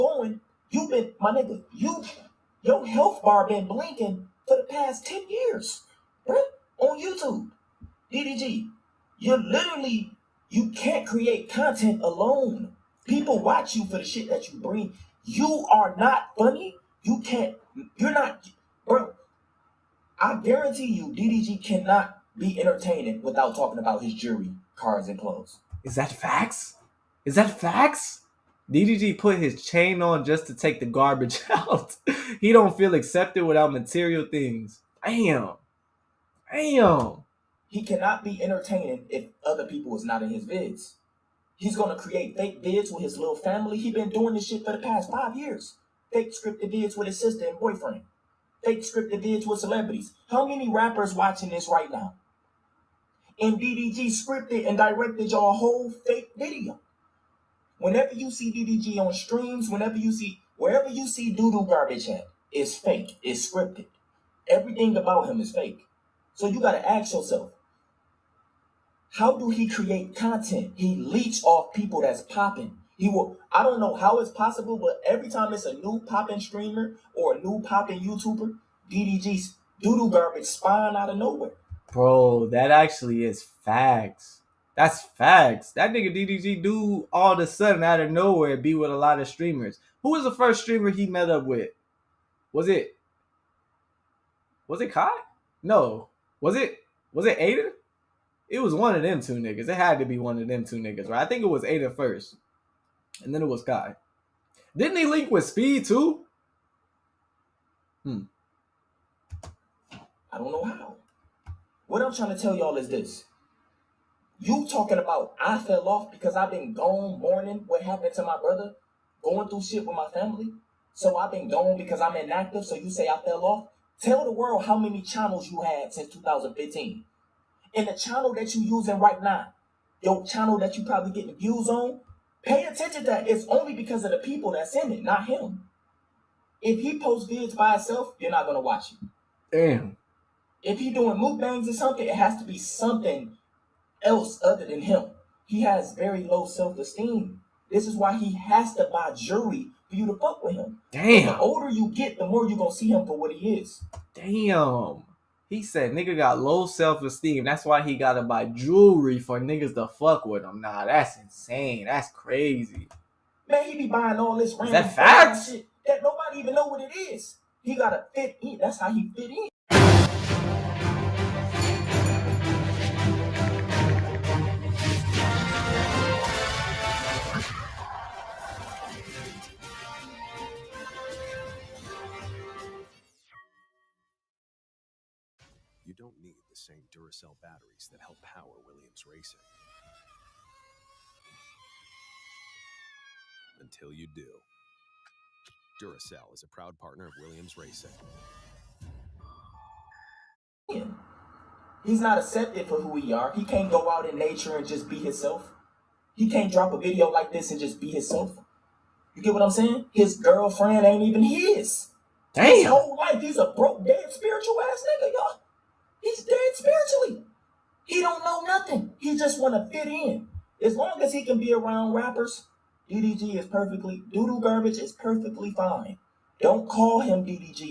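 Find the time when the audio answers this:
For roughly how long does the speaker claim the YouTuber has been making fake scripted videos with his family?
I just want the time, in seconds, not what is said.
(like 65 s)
45 s.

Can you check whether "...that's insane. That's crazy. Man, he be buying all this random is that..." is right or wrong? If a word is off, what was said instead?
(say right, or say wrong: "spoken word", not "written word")
right.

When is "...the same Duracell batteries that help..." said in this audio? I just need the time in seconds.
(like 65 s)
186 s.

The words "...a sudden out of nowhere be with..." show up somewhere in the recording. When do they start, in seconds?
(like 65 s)
87 s.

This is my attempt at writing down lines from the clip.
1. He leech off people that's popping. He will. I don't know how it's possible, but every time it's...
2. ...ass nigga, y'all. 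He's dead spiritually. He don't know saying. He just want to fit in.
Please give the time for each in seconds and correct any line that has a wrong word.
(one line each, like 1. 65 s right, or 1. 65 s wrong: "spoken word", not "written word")
1. 70 s right
2. 214 s wrong: "nothing", not "saying".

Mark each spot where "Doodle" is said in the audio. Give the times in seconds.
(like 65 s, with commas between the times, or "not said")
61 s, 224 s.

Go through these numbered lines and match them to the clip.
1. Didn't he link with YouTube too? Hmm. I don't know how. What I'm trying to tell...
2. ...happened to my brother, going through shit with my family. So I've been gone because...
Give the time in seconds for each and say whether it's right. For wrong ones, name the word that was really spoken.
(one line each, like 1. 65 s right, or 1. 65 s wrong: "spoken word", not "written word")
1. 104 s wrong: "Speed", not "YouTube"
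2. 117 s right.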